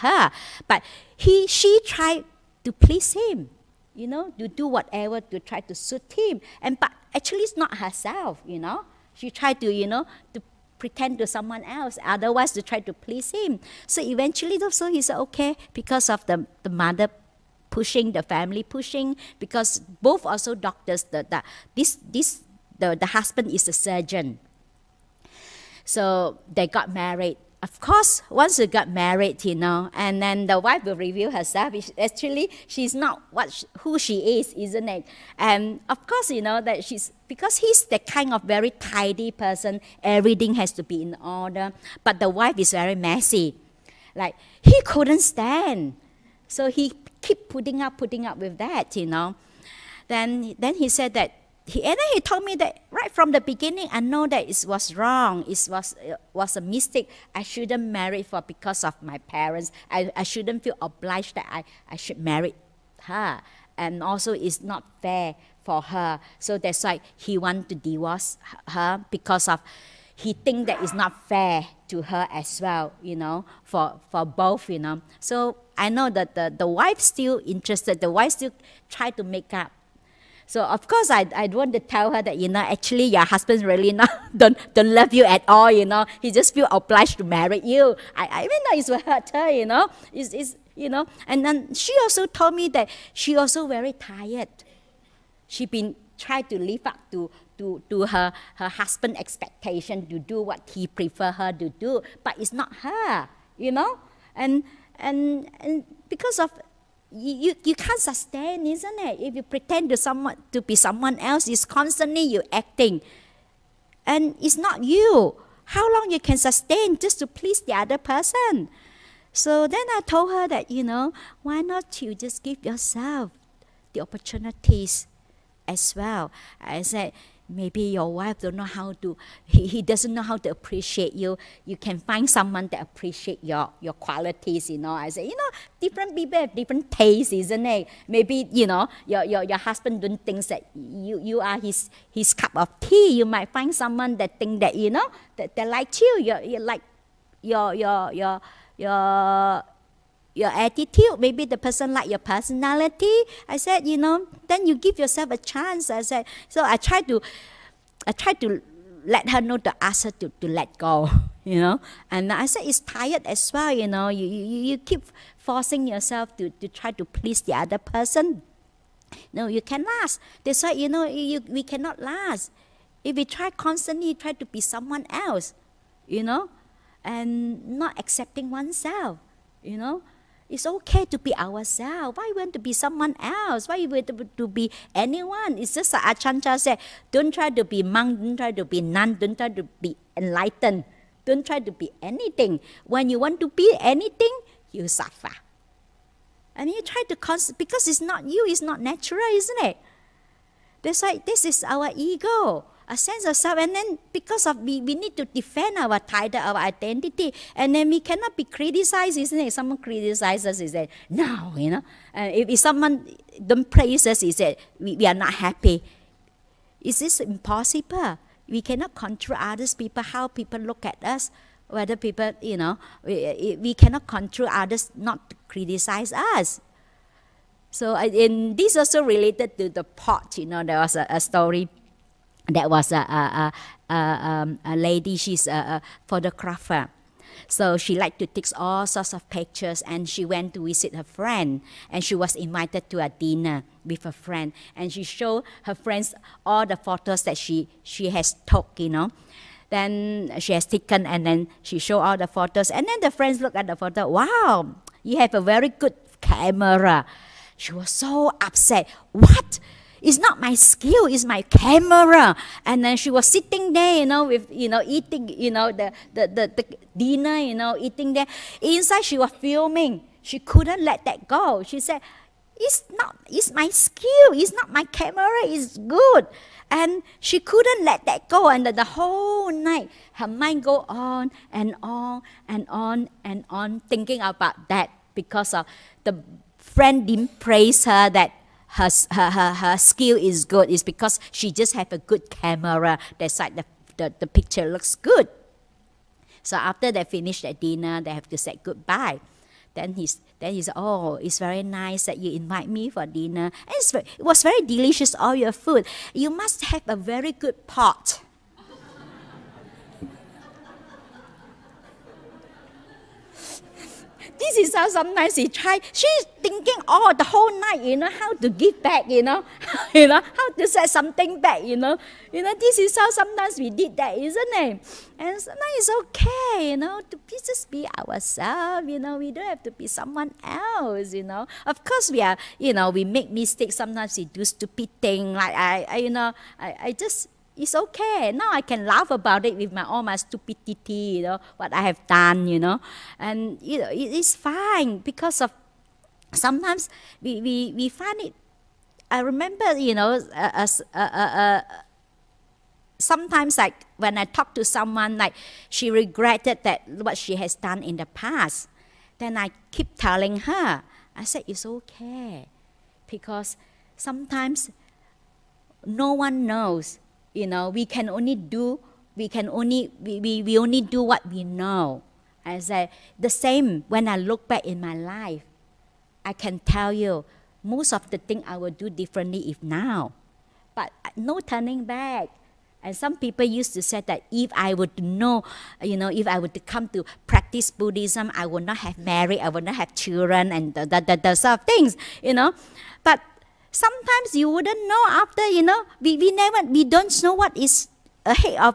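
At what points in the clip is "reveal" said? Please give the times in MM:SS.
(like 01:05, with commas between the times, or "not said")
00:30.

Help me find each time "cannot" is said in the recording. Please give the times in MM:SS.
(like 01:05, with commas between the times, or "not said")
02:51, 03:28, 03:38, 03:43.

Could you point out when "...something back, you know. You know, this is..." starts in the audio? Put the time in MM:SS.
05:20.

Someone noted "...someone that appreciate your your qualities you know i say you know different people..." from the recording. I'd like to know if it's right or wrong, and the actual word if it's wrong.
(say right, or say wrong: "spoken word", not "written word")
right.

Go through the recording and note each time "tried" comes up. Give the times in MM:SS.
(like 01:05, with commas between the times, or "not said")
00:01, 00:09.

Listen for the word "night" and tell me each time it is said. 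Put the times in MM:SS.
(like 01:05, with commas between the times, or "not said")
04:39, 05:17.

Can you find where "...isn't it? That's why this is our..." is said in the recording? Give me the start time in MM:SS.
03:19.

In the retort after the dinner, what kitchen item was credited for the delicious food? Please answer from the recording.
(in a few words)
A very good pot.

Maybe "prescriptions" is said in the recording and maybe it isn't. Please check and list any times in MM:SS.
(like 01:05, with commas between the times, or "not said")
not said.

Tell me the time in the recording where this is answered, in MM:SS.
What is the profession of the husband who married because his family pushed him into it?
00:23.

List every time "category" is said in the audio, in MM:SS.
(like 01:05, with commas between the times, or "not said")
not said.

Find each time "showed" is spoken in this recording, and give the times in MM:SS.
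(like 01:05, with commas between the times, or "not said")
04:05, 04:11.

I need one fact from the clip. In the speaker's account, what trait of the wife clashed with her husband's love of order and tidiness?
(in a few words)
Messy.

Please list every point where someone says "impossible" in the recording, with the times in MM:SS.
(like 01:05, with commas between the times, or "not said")
03:37.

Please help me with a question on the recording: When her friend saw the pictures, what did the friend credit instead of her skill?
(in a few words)
A very good camera.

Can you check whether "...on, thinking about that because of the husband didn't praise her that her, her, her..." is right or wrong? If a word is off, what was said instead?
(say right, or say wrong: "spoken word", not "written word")
wrong: "friend", not "husband".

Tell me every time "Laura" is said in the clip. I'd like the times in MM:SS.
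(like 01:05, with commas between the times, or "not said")
not said.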